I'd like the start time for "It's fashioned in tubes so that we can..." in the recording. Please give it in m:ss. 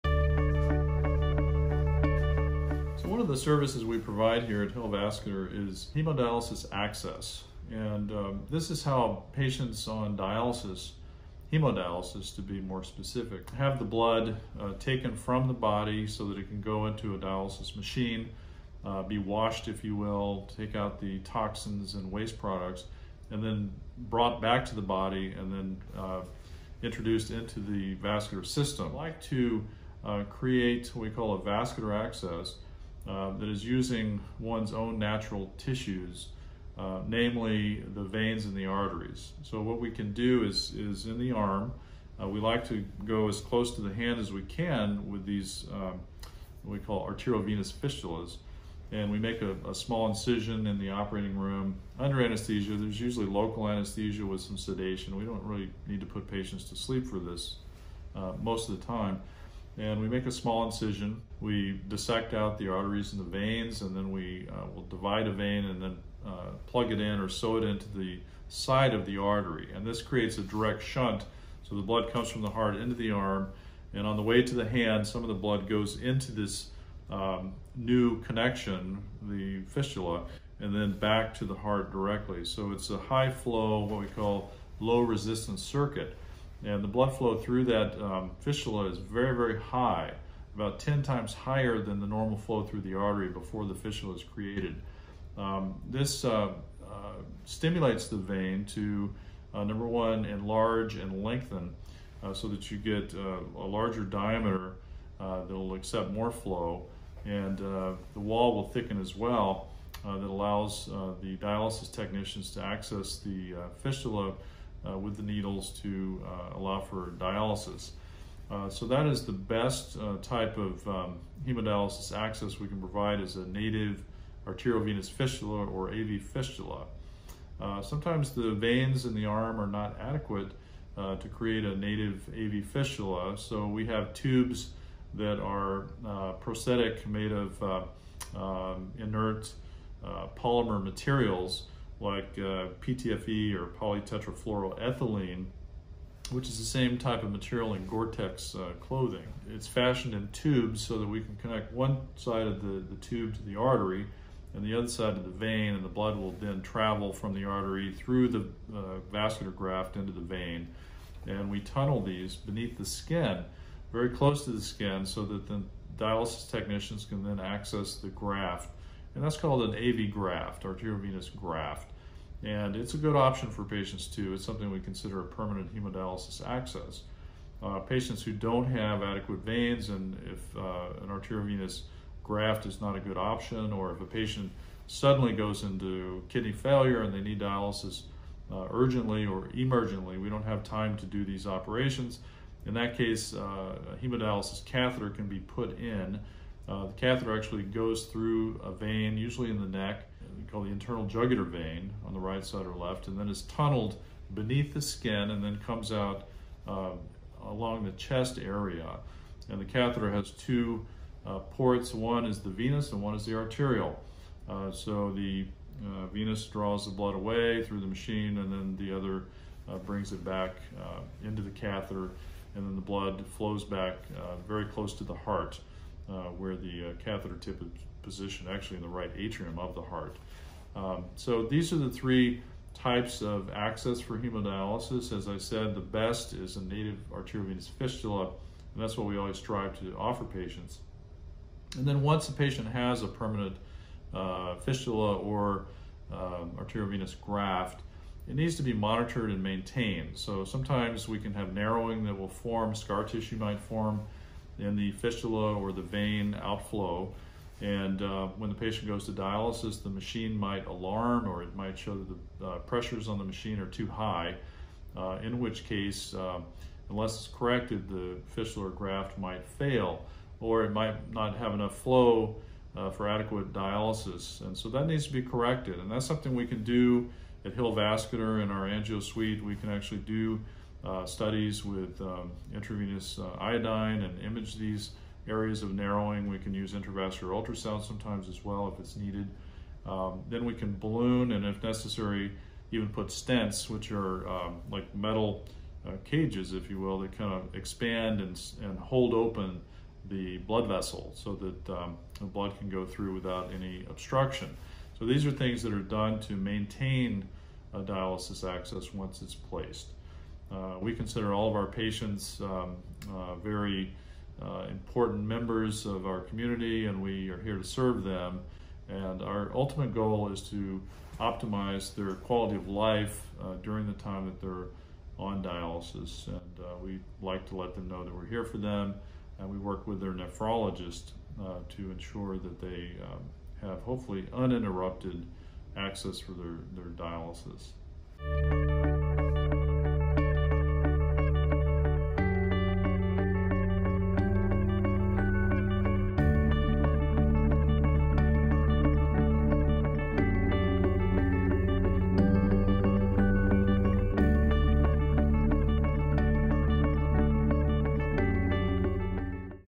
2:29.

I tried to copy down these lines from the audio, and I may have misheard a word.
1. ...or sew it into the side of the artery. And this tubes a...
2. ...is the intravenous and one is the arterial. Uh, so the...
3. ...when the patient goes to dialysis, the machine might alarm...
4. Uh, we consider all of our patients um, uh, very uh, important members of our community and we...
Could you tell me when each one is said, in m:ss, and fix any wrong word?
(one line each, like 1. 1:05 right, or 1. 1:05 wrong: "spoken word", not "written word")
1. 1:07 wrong: "creates", not "tubes"
2. 3:32 wrong: "venous", not "intravenous"
3. 4:18 right
4. 5:10 right.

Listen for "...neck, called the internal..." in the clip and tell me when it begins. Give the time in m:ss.
3:19.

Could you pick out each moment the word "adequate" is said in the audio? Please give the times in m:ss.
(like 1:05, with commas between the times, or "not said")
2:10, 2:59, 4:33.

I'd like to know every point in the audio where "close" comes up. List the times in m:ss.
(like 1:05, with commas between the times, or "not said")
0:43, 2:44, 3:44.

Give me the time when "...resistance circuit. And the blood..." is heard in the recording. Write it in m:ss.
1:25.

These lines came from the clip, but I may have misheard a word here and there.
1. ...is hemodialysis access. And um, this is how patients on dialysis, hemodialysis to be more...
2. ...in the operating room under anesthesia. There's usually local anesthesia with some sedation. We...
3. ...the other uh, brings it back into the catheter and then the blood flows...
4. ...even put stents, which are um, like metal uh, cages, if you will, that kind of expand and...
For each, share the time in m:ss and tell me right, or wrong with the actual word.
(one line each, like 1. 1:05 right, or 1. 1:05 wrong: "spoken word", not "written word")
1. 0:05 right
2. 0:50 right
3. 3:38 right
4. 4:52 right.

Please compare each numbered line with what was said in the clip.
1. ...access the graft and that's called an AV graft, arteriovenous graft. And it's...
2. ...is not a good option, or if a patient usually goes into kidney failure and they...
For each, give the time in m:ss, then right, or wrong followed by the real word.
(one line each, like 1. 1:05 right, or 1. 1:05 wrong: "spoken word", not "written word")
1. 2:47 right
2. 3:02 wrong: "suddenly", not "usually".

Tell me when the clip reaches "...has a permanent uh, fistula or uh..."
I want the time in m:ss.
4:02.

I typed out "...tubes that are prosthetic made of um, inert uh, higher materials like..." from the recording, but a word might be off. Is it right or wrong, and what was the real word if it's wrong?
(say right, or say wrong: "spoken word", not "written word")
wrong: "polymer", not "higher".